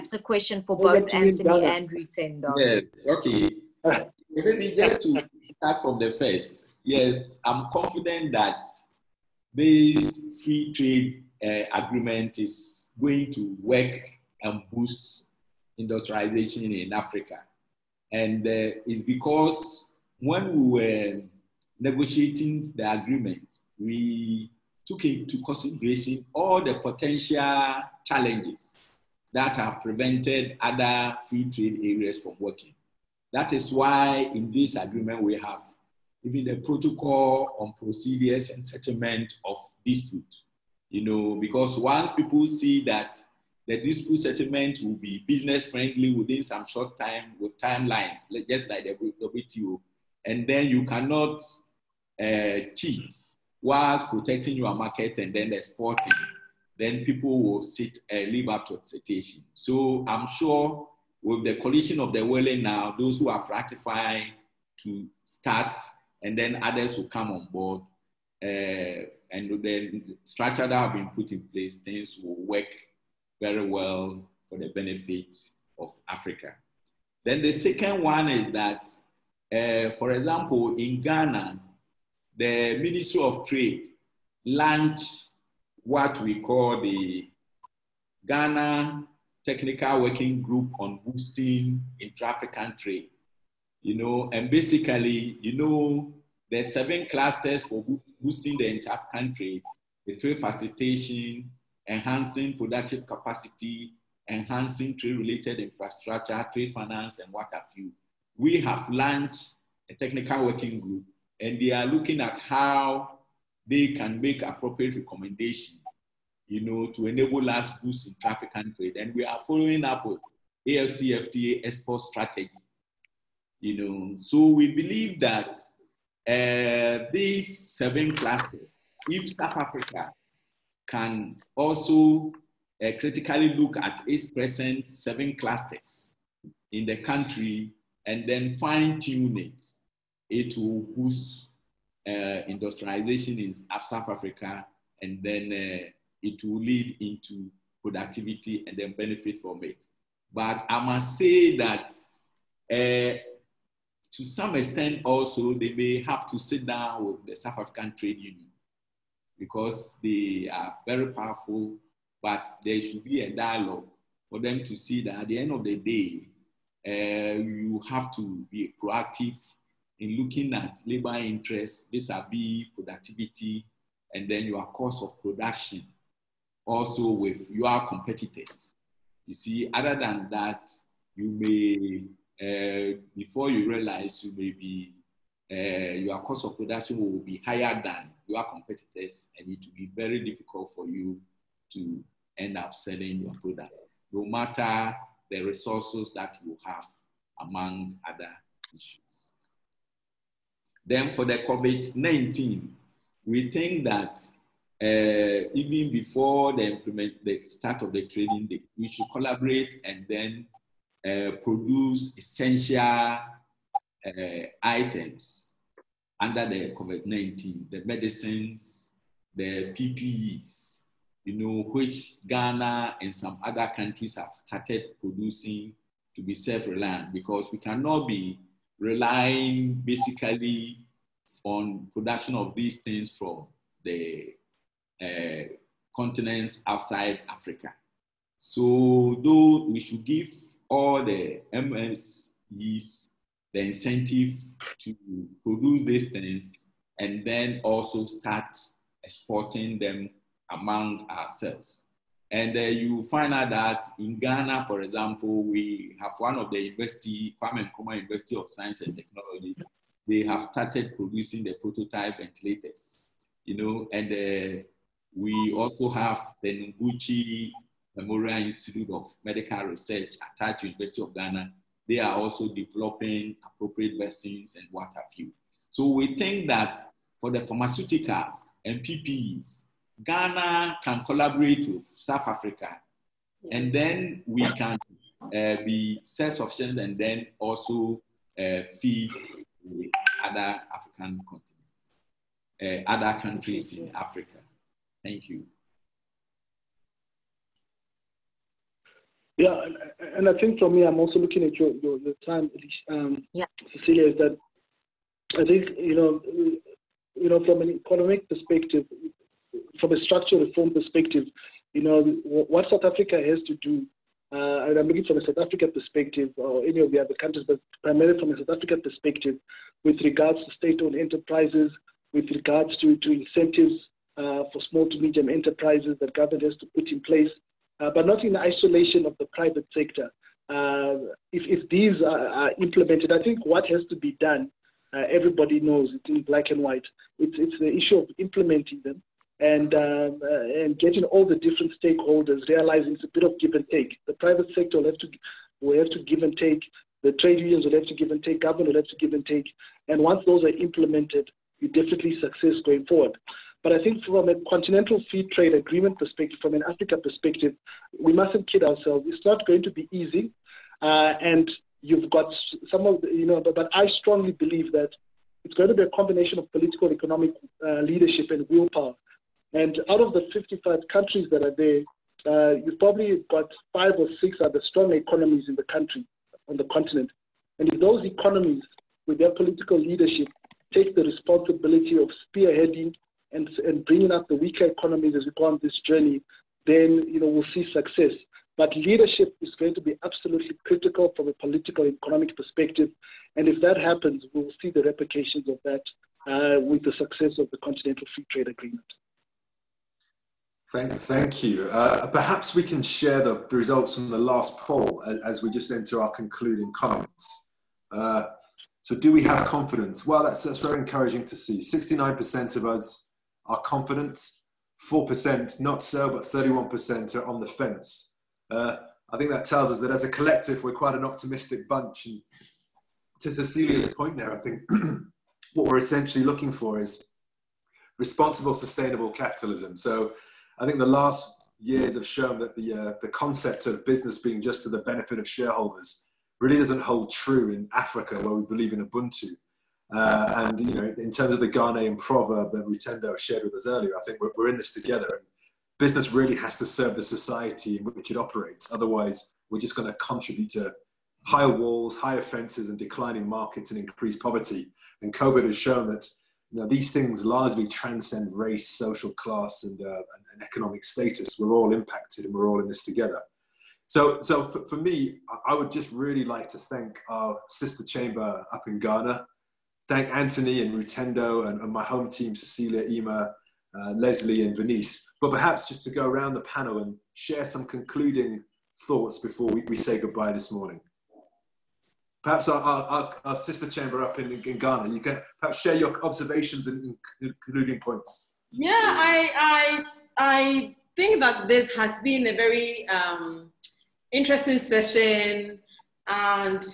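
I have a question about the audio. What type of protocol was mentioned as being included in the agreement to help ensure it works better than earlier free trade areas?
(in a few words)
Settlement of dispute.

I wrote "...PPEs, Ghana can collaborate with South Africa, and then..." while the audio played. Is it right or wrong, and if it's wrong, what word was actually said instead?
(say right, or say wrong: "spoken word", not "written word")
right.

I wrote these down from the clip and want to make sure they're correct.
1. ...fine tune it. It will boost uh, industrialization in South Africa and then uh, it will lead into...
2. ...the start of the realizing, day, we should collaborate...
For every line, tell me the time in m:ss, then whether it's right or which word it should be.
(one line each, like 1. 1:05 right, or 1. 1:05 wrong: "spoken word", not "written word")
1. 2:18 right
2. 3:27 wrong: "training", not "realizing".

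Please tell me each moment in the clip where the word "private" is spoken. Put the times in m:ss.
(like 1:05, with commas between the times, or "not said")
5:29, 5:44.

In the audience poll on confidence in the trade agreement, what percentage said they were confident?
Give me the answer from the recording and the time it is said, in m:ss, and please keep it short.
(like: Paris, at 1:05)
69%, at 6:51.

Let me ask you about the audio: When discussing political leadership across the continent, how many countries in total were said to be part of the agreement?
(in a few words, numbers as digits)
55.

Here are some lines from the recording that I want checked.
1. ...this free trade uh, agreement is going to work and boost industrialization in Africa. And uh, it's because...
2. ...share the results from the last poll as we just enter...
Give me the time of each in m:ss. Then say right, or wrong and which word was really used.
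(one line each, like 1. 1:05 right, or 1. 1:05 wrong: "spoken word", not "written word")
1. 0:09 right
2. 6:42 right.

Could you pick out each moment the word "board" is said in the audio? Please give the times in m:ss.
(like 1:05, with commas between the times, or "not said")
1:07.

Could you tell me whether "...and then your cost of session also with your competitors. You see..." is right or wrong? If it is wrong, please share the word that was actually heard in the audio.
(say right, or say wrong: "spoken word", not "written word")
wrong: "production", not "session".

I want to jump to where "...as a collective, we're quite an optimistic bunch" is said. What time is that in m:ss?
6:59.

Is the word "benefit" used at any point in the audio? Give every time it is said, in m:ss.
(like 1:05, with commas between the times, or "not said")
1:14, 2:28, 7:14.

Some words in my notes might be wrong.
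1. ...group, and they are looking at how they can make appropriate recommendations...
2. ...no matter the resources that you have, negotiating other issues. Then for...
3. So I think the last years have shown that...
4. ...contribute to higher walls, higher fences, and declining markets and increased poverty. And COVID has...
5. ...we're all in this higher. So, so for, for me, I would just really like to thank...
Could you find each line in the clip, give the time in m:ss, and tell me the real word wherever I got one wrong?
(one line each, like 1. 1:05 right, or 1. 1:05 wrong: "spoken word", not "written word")
1. 1:50 right
2. 3:14 wrong: "among", not "negotiating"
3. 7:09 right
4. 7:29 right
5. 7:42 wrong: "together", not "higher".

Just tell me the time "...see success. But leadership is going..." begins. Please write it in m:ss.
6:27.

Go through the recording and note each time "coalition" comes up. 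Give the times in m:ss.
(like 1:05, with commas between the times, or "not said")
1:01.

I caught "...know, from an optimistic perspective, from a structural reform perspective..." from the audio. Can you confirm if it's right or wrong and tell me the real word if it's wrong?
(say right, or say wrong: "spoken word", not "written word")
wrong: "economic", not "optimistic".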